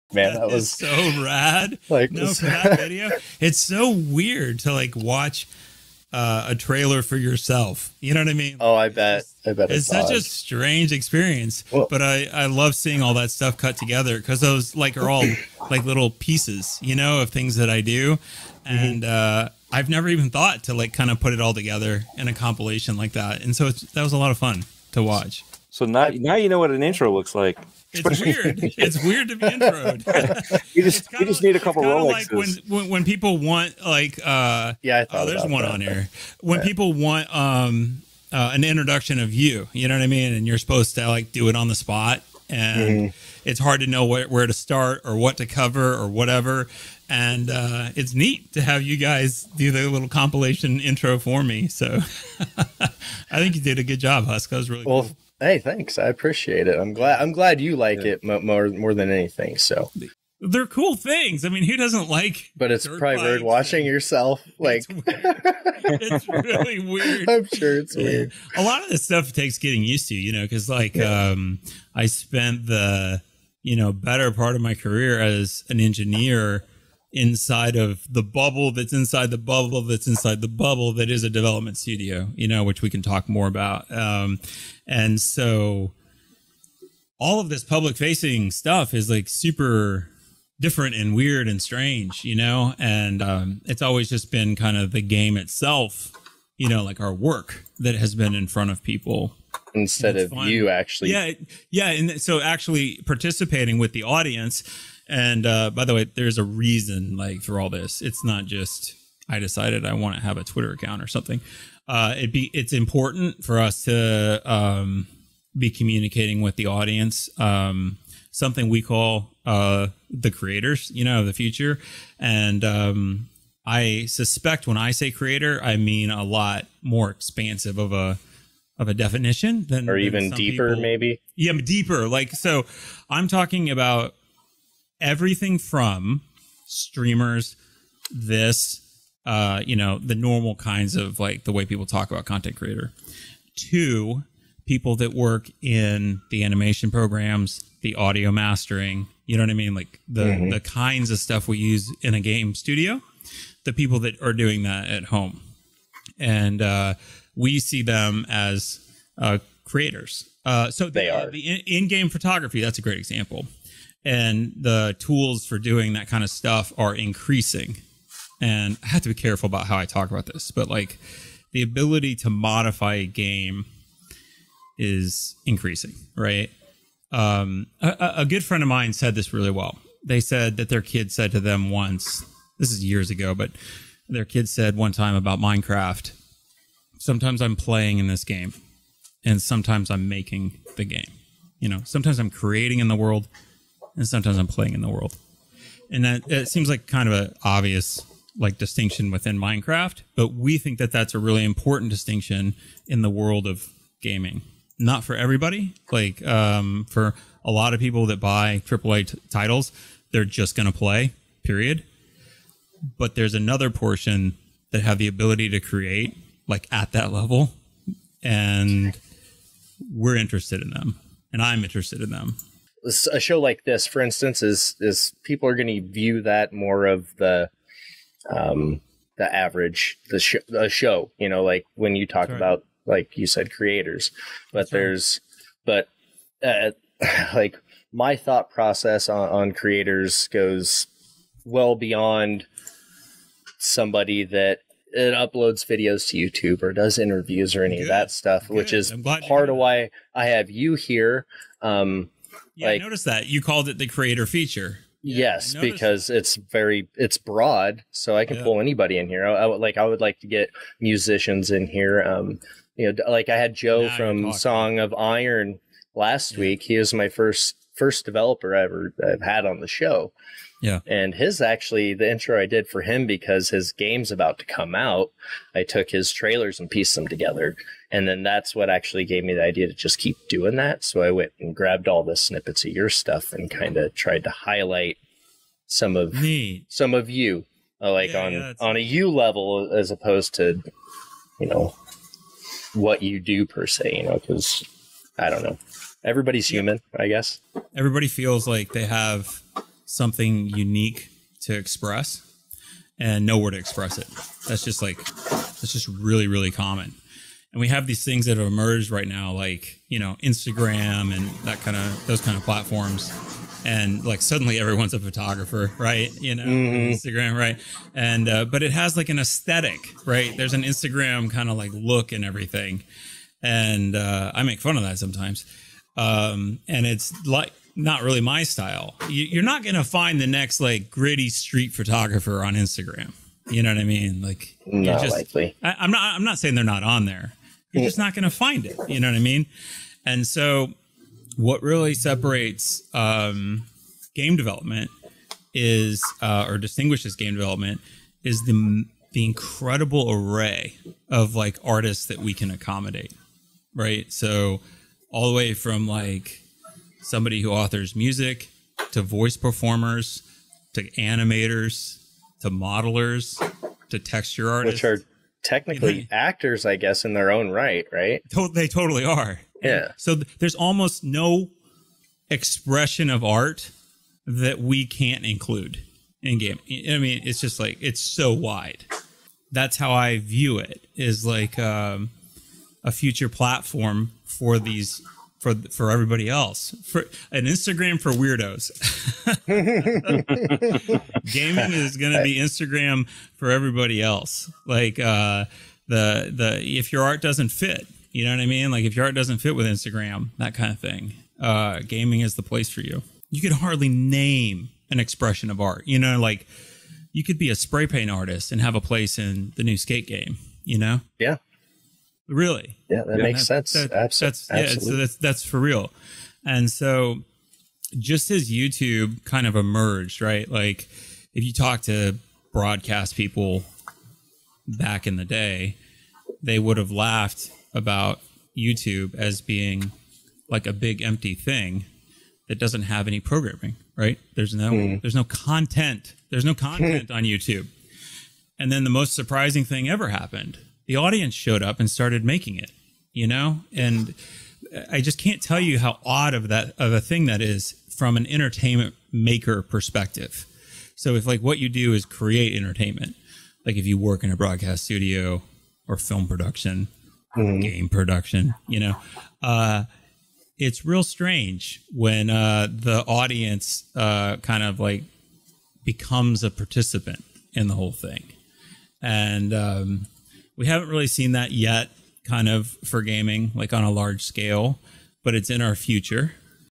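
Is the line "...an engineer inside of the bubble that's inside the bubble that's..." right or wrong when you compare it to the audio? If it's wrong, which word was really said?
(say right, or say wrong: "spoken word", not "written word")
right.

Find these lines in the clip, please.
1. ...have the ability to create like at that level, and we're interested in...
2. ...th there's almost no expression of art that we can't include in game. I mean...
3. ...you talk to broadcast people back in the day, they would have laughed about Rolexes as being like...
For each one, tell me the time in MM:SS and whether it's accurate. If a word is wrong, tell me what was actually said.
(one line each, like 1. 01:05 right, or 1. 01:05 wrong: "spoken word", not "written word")
1. 03:34 right
2. 06:10 right
3. 07:01 wrong: "YouTube", not "Rolexes".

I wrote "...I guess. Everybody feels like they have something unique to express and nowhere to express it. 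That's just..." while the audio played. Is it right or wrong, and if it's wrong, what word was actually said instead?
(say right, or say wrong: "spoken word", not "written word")
right.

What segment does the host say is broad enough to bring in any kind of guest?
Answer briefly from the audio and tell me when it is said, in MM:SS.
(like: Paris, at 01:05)
the creator feature, at 04:13.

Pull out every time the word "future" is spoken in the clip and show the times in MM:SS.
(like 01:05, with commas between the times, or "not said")
02:01, 06:22, 07:55.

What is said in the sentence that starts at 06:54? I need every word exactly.
Yeah, so that's that's for real.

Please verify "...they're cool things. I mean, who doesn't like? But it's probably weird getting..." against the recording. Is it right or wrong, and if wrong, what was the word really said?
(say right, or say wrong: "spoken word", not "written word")
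wrong: "watching", not "getting".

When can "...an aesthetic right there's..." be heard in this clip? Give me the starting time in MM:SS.
05:19.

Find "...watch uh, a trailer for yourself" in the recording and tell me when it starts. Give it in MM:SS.
00:04.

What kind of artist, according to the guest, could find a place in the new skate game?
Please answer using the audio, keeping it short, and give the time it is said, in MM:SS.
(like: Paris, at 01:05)
spray paint artist, at 06:47.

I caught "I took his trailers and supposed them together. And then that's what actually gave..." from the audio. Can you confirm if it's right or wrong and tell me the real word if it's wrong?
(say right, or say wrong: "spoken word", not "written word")
wrong: "pieced", not "supposed".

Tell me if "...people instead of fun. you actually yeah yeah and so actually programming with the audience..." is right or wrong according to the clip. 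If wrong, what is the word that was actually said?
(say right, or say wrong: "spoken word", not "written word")
wrong: "participating", not "programming".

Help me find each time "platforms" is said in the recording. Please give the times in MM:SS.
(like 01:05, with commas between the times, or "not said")
05:12, 06:23.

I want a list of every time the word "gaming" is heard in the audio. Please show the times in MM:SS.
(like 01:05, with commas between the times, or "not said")
03:24, 06:31, 06:41, 07:53.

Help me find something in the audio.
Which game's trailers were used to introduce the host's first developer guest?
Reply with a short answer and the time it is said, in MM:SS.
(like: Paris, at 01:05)
Song of Iron, at 04:24.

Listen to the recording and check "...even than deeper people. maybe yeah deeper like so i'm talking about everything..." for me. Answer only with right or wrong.
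right.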